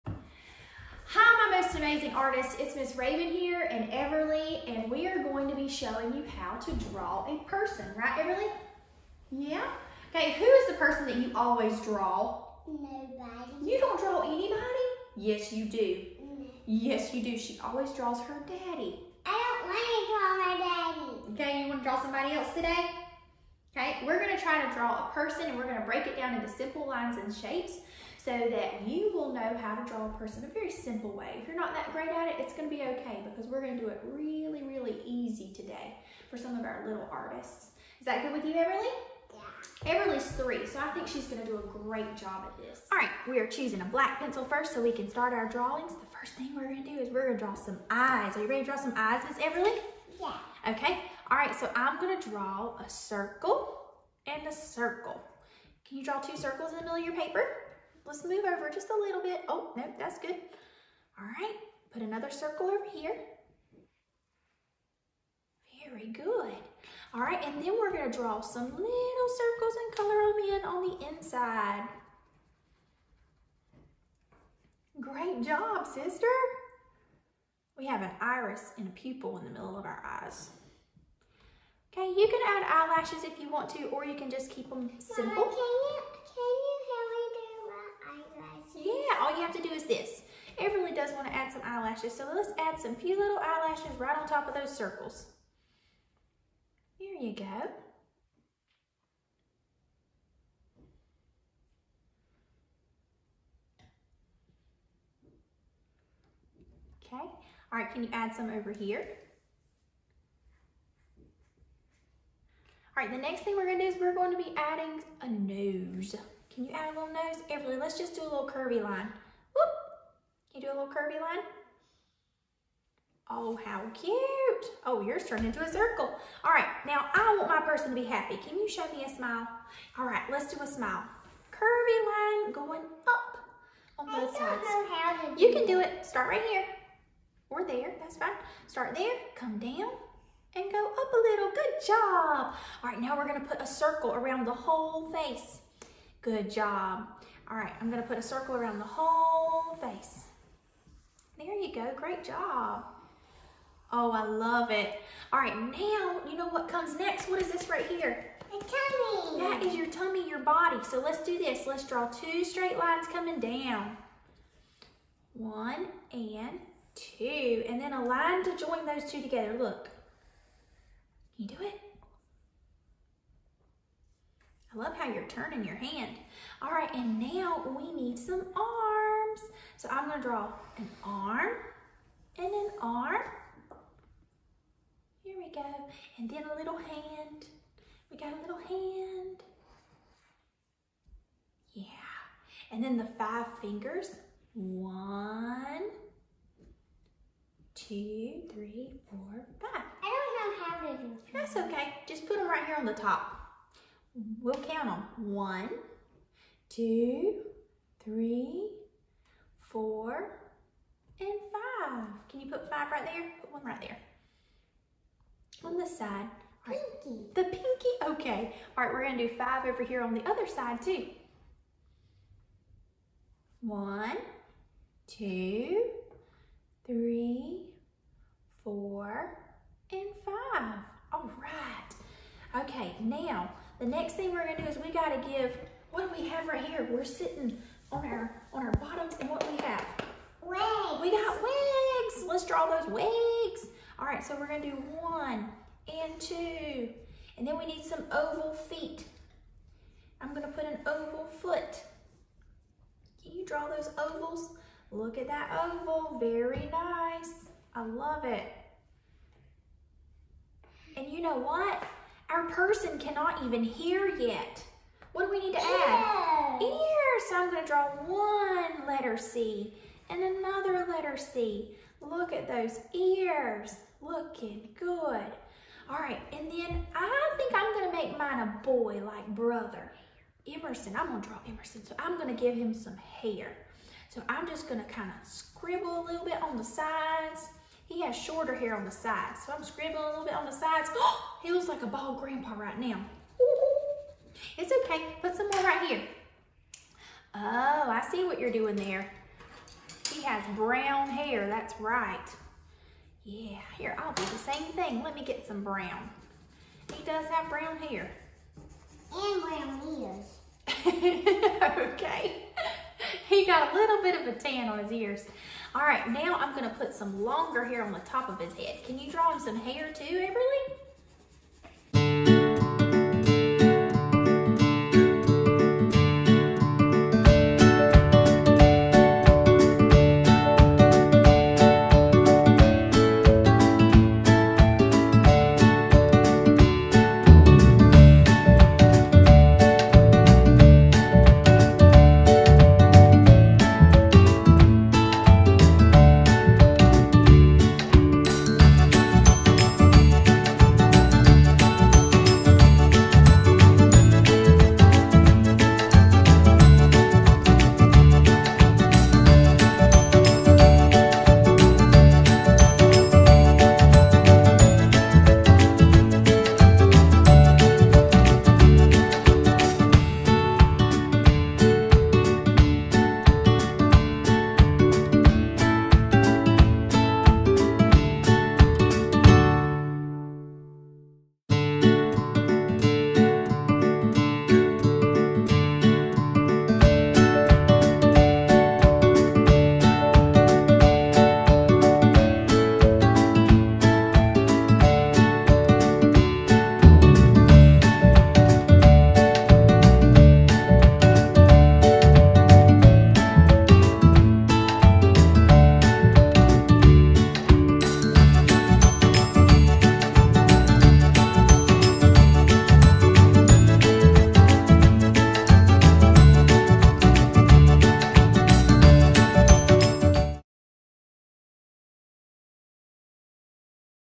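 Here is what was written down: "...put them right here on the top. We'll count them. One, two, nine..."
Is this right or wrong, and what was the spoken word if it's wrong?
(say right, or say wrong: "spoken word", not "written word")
wrong: "three", not "nine".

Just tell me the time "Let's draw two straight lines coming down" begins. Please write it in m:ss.
2:41.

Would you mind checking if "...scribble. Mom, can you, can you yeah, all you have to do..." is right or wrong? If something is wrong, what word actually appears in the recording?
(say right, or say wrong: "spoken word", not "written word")
wrong: "simple", not "scribble".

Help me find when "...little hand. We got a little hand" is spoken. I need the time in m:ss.
3:06.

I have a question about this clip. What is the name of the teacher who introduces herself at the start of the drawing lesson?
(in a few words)
Miss Rabon.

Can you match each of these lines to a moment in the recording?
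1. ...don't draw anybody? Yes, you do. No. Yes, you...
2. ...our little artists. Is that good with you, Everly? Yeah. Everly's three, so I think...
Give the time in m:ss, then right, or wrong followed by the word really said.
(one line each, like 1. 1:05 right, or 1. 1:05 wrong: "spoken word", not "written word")
1. 0:13 right
2. 0:36 right.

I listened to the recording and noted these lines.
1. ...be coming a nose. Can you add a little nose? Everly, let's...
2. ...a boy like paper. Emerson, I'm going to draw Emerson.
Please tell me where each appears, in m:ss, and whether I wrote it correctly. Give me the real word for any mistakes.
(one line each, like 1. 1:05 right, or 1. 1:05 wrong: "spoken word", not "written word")
1. 1:54 wrong: "adding", not "coming"
2. 4:38 wrong: "brother", not "paper".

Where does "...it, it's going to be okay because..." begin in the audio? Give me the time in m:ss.
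0:32.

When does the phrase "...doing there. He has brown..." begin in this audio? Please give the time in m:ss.
4:58.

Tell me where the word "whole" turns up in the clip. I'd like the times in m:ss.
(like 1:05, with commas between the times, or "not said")
2:24, 2:28.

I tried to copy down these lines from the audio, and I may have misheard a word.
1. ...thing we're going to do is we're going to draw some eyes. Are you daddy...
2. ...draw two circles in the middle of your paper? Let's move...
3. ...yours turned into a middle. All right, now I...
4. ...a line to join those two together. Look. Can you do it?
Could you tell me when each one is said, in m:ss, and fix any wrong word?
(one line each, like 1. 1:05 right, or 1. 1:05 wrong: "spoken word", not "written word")
1. 0:46 wrong: "ready", not "daddy"
2. 0:56 right
3. 2:05 wrong: "circle", not "middle"
4. 2:47 right.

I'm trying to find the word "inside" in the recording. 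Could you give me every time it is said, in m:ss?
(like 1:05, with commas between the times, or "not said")
1:11.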